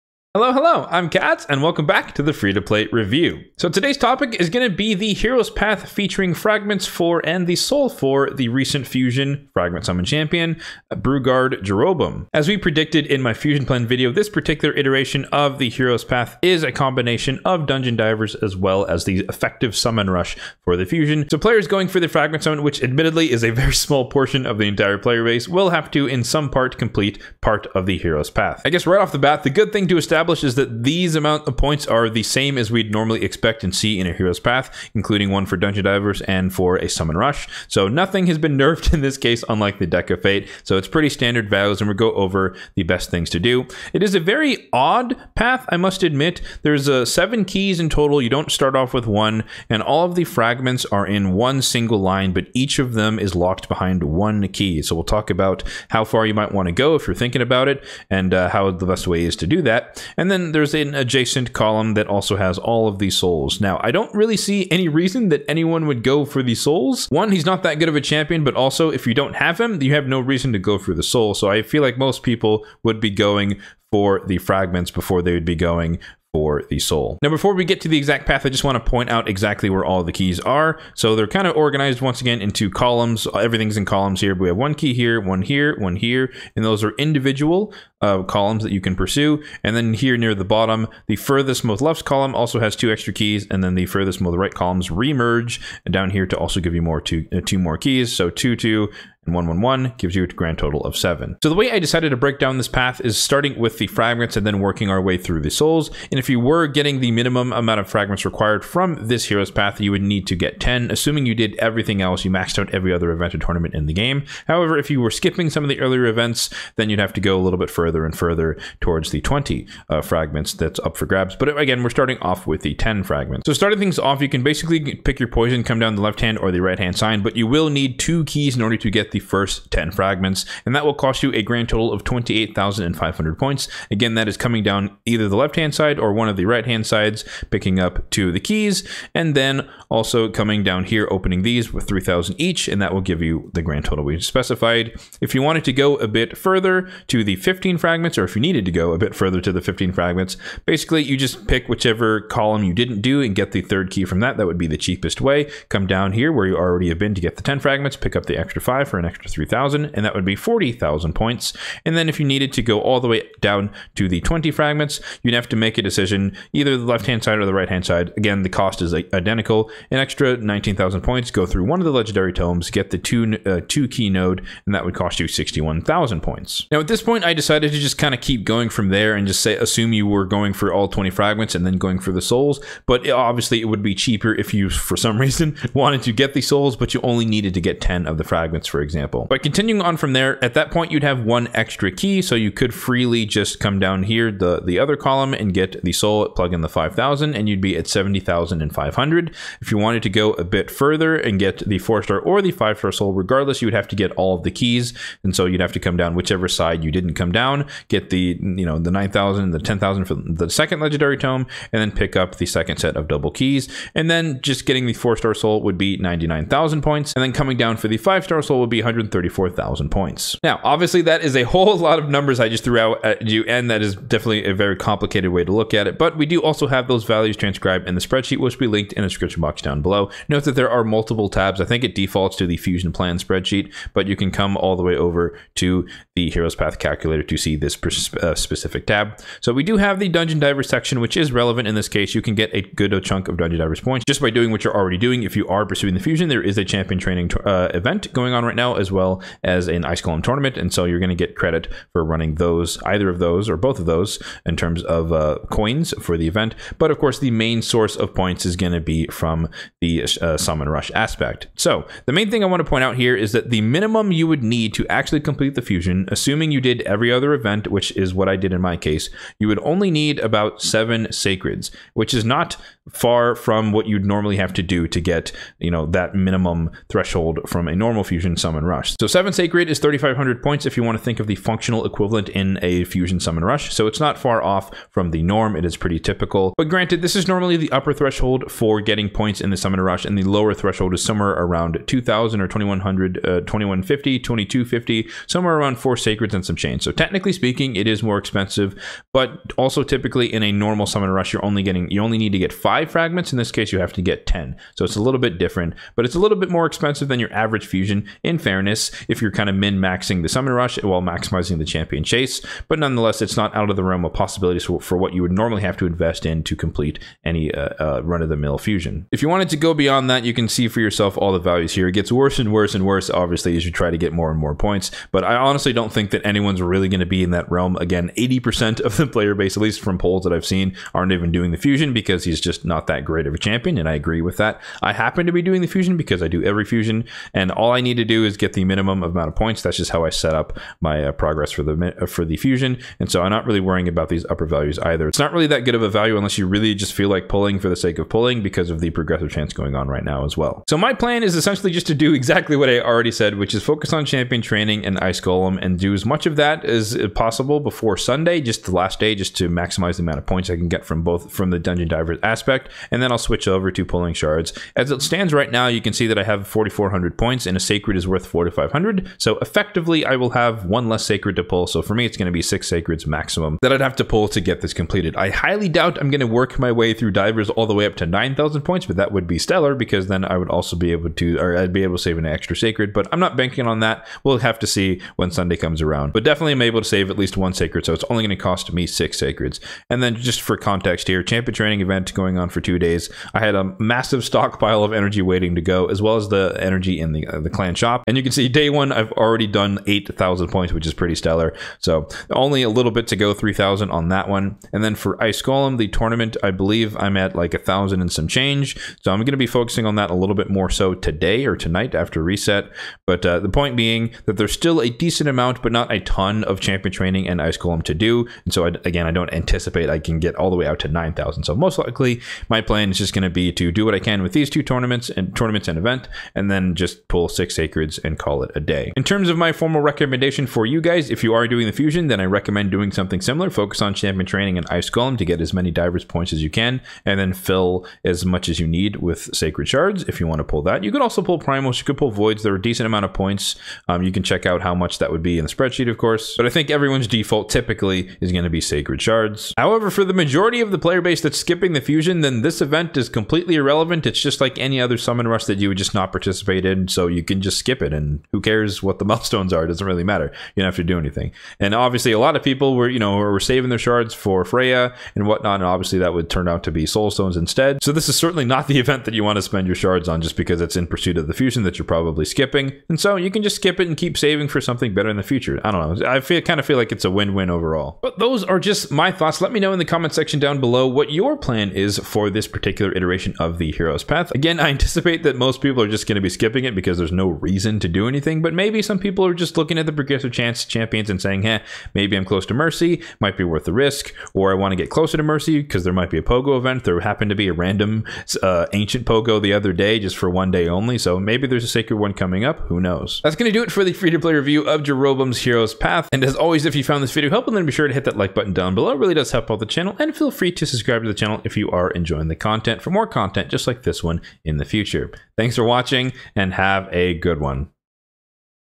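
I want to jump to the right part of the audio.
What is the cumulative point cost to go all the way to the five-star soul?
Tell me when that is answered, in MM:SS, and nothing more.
03:38.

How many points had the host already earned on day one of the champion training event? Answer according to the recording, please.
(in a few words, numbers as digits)
8,000.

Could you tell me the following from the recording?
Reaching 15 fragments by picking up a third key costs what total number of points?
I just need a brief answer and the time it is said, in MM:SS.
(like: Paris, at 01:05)
40,000, at 02:40.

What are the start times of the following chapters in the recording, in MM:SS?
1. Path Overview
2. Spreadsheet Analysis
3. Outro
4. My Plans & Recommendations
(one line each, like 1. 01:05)
1. 00:12
2. 03:40
3. 07:58
4. 05:50.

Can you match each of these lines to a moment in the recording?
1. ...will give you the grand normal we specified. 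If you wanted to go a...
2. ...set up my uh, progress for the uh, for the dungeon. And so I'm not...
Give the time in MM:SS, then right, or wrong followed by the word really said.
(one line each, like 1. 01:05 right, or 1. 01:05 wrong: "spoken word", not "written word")
1. 02:22 wrong: "total", not "normal"
2. 05:40 wrong: "fusion", not "dungeon".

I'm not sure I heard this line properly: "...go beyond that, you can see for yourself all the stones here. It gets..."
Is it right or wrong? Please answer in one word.
wrong.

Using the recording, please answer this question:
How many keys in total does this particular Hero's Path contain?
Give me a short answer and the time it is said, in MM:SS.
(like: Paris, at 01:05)
7, at 00:47.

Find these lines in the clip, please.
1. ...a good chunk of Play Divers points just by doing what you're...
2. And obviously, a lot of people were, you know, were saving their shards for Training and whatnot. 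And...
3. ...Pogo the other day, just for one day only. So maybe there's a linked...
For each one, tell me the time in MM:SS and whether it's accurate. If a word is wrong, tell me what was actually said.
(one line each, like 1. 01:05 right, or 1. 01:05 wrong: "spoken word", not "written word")
1. 04:02 wrong: "Dungeon", not "Play"
2. 07:41 wrong: "Freyja", not "Training"
3. 08:19 wrong: "sacred", not "linked".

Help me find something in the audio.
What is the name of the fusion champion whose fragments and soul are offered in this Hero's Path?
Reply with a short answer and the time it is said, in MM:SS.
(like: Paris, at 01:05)
Brugard Jeroboam, at 00:10.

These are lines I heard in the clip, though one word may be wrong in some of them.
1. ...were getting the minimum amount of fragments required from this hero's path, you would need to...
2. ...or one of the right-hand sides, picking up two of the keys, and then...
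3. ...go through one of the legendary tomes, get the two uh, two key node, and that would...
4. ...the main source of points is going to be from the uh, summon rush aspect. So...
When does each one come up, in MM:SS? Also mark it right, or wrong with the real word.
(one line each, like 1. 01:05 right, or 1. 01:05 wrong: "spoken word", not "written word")
1. 01:46 right
2. 02:15 right
3. 02:51 right
4. 04:17 right.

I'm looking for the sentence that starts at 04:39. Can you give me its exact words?
So seven sacred is 3,500 points if you want to think of the functional equivalent in a fusion summon rush.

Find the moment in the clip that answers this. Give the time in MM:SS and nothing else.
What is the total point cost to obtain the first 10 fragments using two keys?
02:12.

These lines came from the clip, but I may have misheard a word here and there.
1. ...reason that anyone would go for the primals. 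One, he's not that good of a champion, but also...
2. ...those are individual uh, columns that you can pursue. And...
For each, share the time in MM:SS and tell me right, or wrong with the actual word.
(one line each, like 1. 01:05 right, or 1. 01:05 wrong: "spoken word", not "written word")
1. 01:04 wrong: "souls", not "primals"
2. 01:26 right.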